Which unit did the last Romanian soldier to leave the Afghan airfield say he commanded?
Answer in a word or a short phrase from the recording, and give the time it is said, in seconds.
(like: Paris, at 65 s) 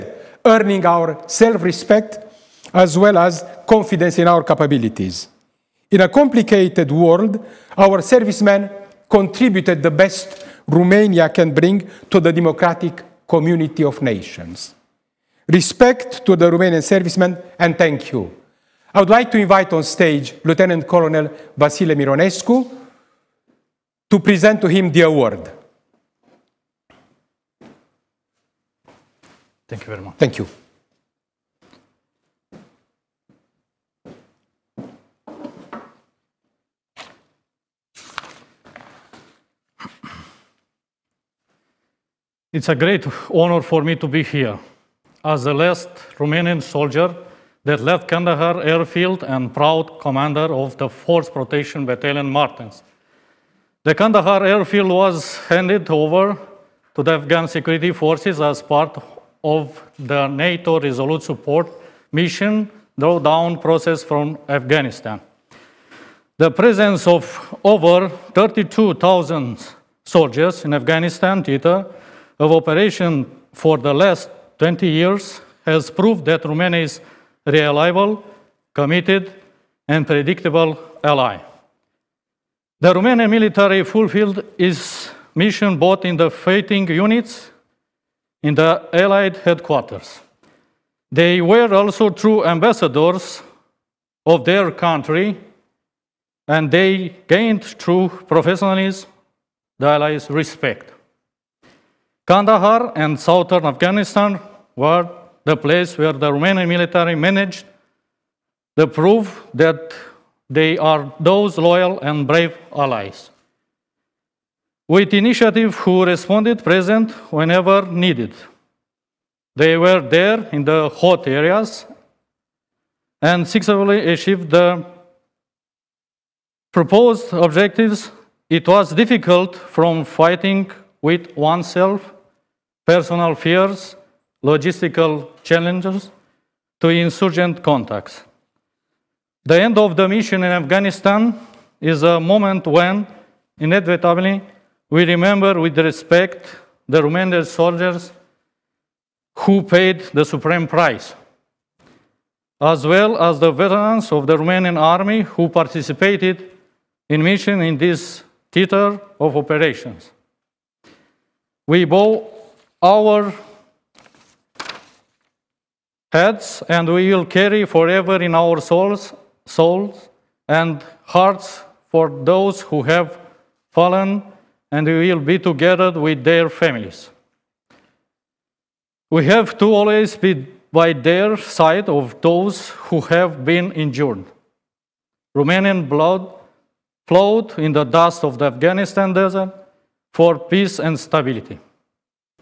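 4th Protection Battalion, at 50 s.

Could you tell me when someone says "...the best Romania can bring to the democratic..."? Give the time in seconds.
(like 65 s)
9 s.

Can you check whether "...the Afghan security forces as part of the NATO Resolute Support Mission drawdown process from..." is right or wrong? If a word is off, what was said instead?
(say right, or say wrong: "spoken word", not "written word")
right.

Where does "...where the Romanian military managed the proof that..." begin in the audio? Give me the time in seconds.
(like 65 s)
105 s.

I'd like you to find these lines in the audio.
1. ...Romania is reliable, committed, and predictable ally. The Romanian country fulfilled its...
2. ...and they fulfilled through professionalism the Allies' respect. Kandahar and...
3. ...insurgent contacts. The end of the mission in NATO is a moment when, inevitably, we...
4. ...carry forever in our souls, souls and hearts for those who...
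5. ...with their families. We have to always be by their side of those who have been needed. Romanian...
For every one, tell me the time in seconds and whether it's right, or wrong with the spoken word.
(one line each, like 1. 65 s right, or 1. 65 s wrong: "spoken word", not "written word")
1. 76 s wrong: "military", not "country"
2. 96 s wrong: "gained", not "fulfilled"
3. 136 s wrong: "Afghanistan", not "NATO"
4. 167 s right
5. 175 s wrong: "injured", not "needed".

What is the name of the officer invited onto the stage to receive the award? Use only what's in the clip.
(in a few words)
Vasile Mironescu.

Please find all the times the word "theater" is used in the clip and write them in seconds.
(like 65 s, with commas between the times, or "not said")
71 s, 158 s.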